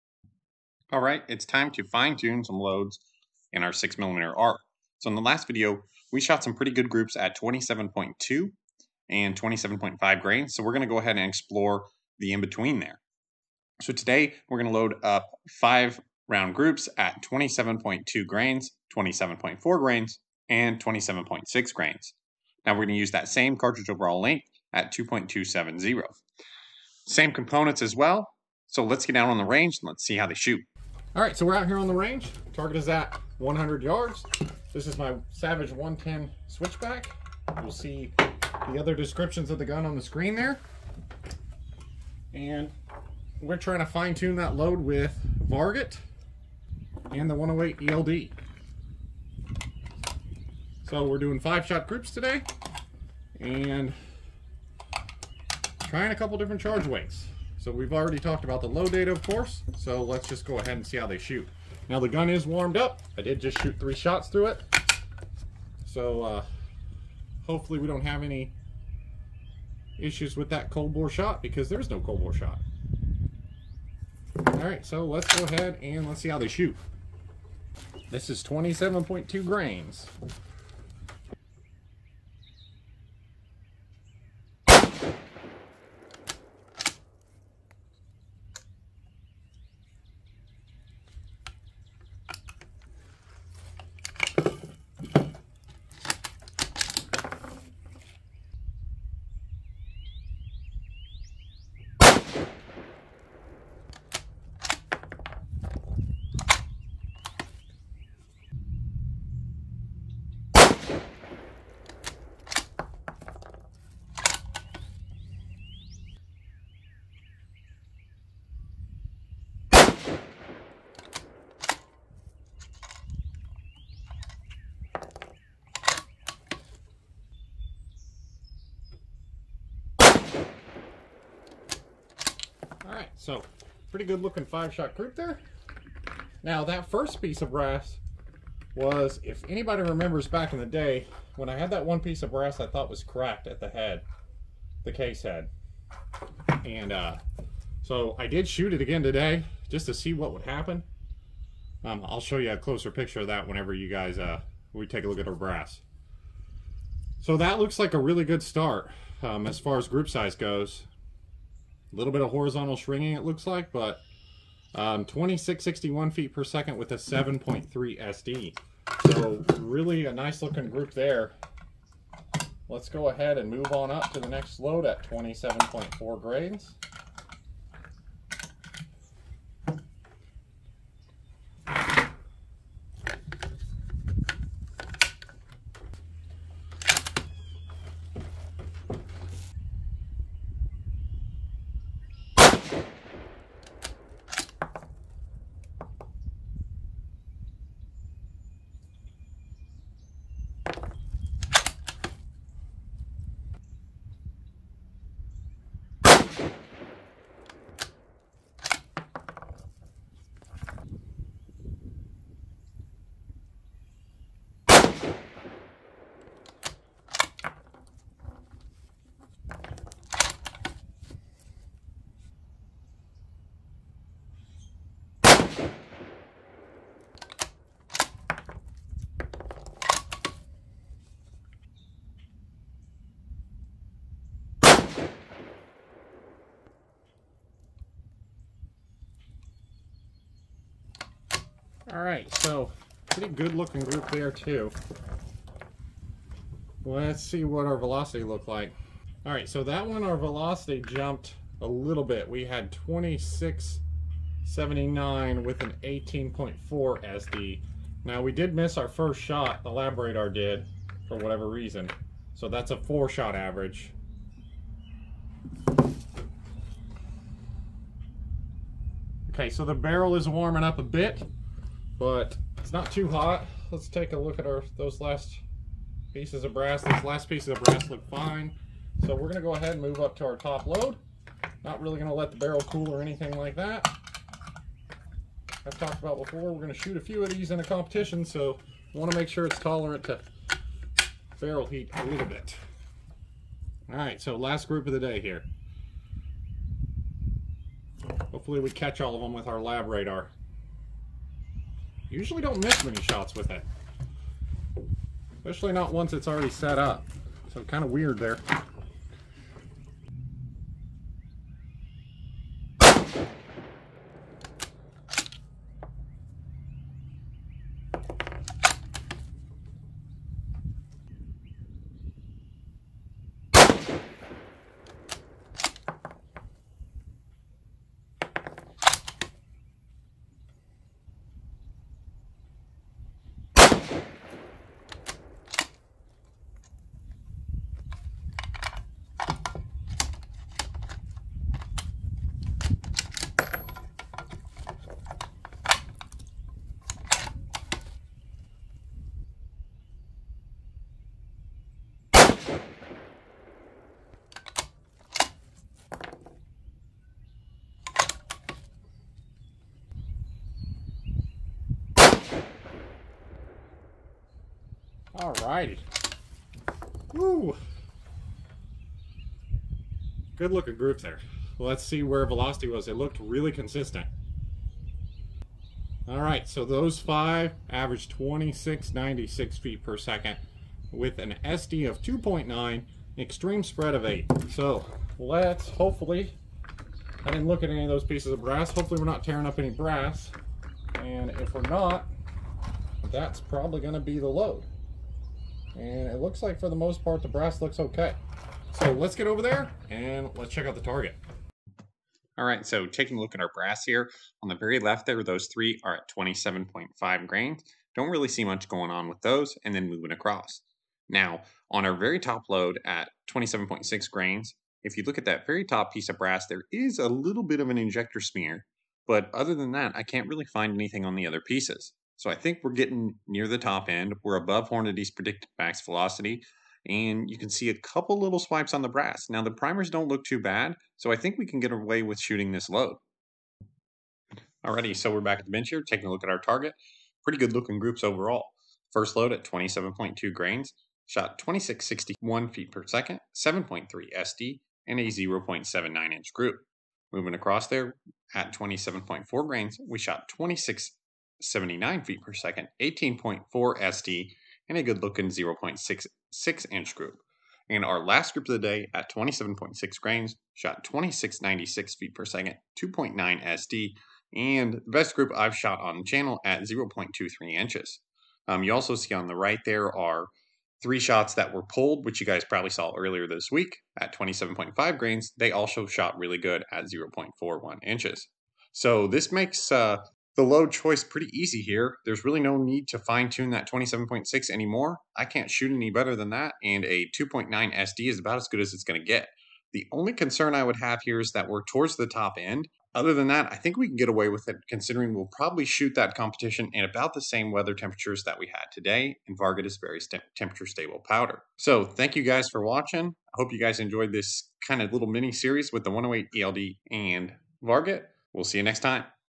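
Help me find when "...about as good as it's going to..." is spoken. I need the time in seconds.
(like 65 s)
488 s.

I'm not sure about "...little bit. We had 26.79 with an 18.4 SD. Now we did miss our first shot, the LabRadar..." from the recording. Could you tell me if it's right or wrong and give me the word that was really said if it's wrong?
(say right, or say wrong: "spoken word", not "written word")
right.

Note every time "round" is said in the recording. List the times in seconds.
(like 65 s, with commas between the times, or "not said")
16 s.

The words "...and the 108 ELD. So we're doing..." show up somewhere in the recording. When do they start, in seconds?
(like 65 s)
47 s.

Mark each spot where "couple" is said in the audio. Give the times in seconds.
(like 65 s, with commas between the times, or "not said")
56 s, 427 s.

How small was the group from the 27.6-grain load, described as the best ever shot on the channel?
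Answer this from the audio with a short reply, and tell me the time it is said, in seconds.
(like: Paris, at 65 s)
0.23 inches, at 466 s.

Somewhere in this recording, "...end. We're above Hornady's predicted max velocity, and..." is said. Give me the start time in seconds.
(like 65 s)
423 s.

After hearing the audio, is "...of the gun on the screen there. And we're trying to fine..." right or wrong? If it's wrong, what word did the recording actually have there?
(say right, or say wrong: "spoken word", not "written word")
right.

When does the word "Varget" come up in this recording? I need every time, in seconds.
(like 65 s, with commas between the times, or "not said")
45 s, 499 s, 507 s.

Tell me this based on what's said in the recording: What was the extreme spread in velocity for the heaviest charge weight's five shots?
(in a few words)
8.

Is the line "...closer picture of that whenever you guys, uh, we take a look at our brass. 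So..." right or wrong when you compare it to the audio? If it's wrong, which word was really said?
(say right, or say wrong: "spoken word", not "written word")
right.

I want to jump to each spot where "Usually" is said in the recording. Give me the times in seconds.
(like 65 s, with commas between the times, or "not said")
302 s.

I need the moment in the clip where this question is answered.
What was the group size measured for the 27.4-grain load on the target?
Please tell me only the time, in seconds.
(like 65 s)
455 s.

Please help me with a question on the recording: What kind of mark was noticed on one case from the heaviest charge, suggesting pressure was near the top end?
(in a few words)
ejector smear.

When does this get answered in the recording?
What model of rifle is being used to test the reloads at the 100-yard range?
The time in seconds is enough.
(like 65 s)
35 s.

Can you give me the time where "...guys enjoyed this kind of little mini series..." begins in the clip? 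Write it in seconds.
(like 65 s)
503 s.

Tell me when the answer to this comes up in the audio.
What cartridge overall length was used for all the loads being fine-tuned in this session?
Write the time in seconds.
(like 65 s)
24 s.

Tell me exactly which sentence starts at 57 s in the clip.
So we've already talked about the load data, of course, so let's just go ahead and see how they shoot.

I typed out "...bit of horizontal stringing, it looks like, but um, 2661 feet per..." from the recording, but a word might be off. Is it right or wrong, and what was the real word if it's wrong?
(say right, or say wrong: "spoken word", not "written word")
right.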